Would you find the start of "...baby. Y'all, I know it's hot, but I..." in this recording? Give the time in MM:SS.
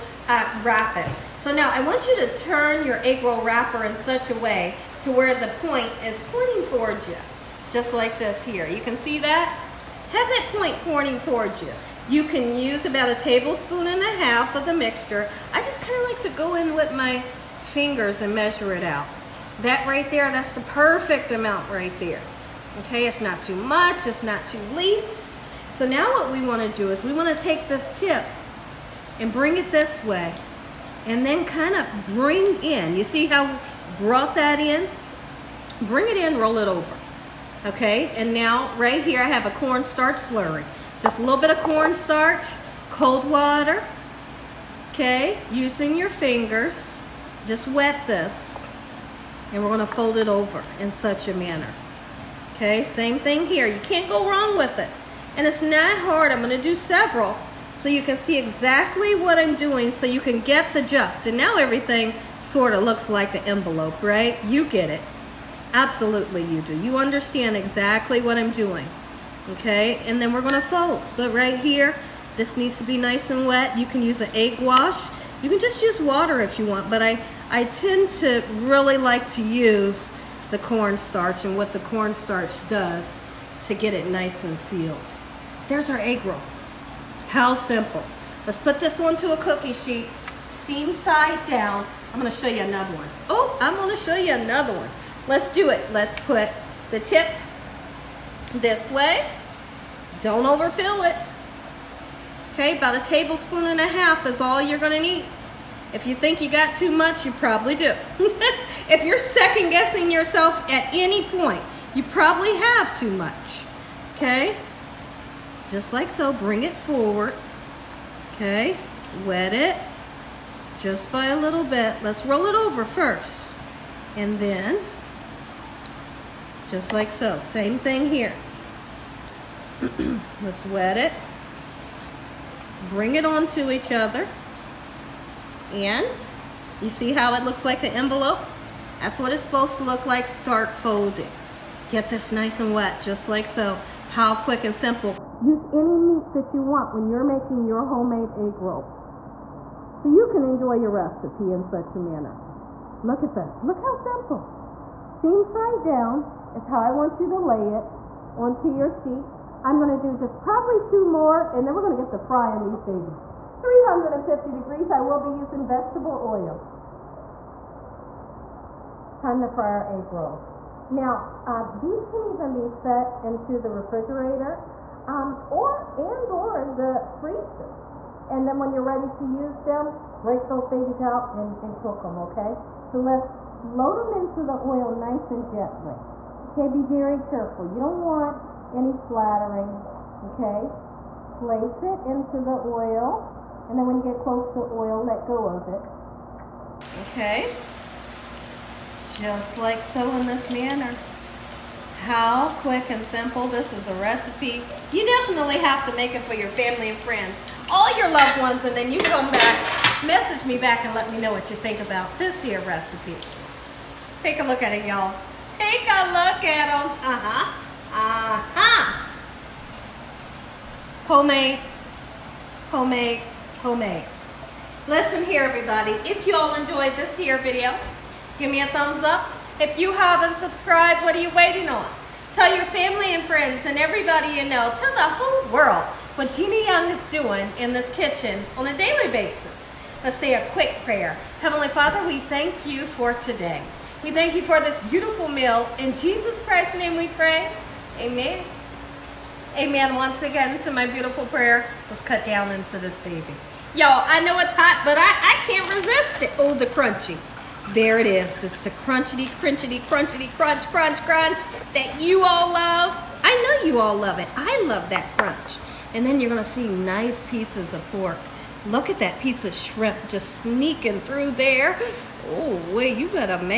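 04:12.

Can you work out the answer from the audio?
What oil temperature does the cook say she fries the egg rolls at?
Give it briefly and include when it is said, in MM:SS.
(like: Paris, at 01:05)
350 degrees, at 02:43.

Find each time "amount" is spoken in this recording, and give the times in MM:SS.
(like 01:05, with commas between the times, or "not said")
00:21.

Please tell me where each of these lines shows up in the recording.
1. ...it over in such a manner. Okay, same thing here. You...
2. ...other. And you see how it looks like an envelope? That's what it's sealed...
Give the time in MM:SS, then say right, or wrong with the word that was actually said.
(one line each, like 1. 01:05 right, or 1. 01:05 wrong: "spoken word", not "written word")
1. 00:50 right
2. 02:13 wrong: "supposed", not "sealed".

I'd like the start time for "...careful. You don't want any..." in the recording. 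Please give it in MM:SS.
03:07.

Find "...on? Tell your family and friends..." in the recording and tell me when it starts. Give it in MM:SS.
03:51.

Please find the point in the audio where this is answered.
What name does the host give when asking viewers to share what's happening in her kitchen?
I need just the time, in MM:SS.
03:56.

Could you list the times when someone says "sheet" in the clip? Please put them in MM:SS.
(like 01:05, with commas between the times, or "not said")
01:29, 02:38.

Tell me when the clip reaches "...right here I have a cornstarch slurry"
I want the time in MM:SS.
00:38.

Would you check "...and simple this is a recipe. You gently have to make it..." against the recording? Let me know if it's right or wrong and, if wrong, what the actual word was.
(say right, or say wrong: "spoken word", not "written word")
wrong: "definitely", not "gently".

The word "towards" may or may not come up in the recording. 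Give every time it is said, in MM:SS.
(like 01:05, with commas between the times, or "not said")
00:06, 00:11.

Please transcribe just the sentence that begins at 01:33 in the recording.
Oh, I'm gonna show you another one.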